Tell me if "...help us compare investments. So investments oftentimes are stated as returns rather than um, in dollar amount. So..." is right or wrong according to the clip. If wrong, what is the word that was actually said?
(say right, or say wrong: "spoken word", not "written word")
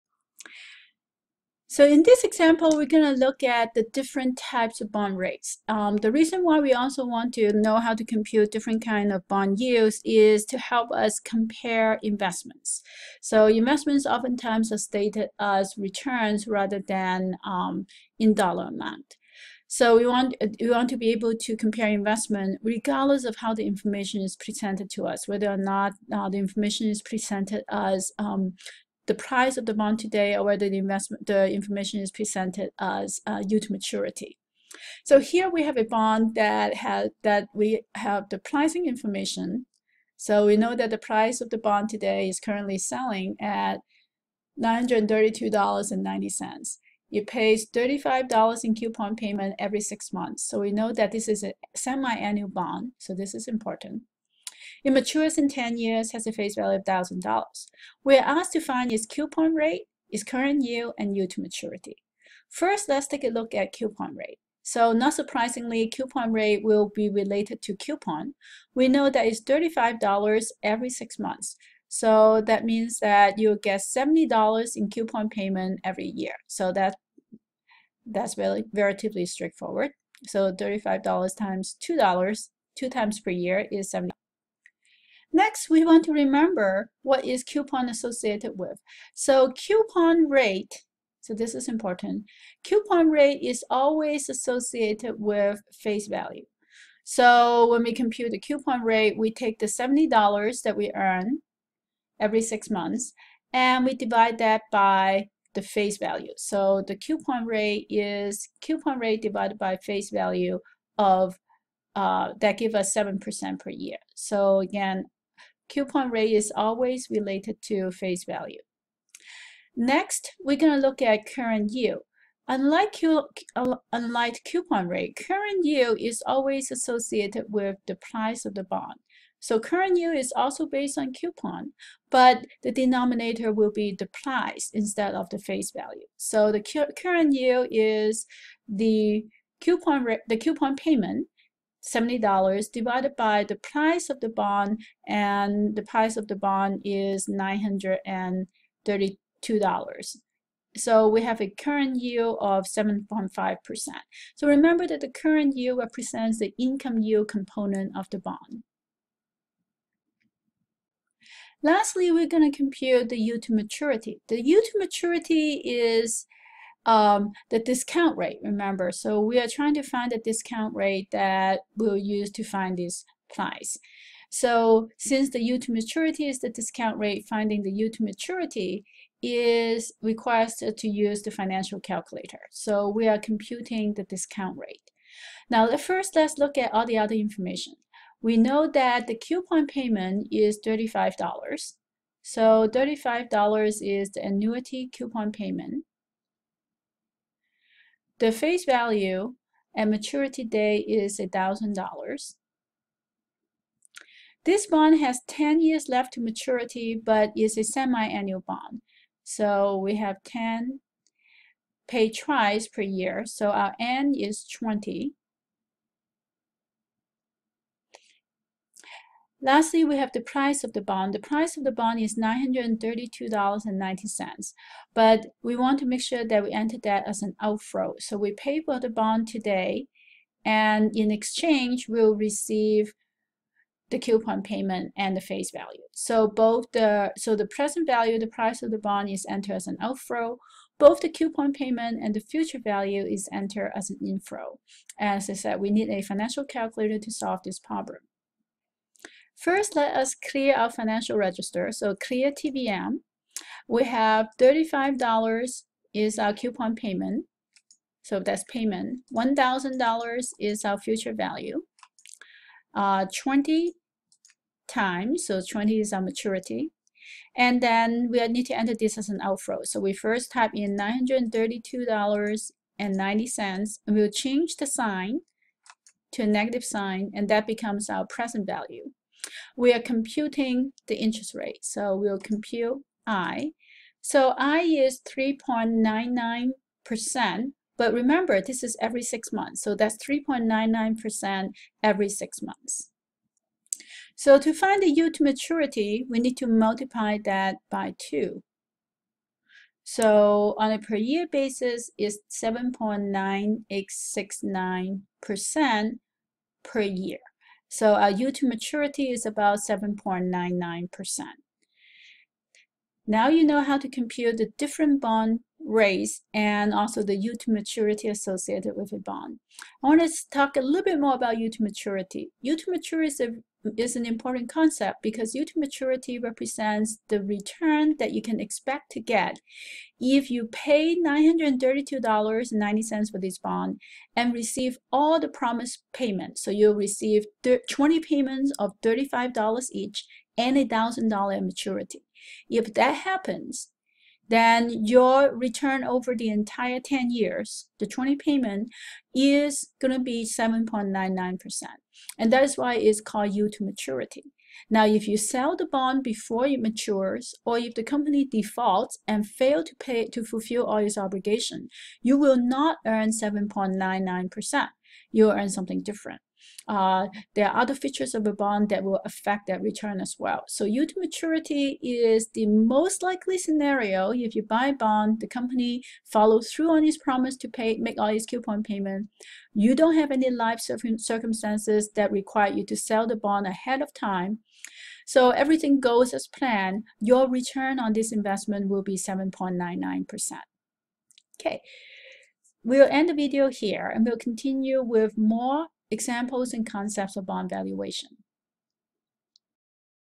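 right.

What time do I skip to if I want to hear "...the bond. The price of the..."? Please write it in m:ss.
3:40.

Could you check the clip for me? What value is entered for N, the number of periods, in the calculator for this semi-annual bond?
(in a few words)
20.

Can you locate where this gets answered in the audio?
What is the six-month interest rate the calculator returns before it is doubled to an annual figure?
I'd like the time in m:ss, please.
4:44.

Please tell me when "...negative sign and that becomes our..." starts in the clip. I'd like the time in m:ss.
4:36.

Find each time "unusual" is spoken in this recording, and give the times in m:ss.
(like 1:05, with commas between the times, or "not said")
not said.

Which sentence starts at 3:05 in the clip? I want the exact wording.
Now first let's look at all the other information.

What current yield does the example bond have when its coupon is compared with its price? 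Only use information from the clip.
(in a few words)
7.5%.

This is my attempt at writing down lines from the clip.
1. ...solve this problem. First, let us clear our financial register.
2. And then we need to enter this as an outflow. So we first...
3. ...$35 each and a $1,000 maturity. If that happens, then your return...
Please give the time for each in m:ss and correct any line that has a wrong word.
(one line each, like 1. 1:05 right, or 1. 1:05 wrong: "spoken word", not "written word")
1. 4:07 right
2. 4:27 right
3. 5:38 right.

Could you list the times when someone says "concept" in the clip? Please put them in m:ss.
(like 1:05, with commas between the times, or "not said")
5:24, 6:36.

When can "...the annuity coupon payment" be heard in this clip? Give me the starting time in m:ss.
3:14.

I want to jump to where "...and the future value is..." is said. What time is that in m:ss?
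4:02.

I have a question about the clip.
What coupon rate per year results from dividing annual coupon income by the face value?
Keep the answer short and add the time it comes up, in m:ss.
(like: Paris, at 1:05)
7%, at 1:52.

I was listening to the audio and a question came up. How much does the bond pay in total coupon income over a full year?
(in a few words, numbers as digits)
$70.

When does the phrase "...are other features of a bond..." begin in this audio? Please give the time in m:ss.
6:07.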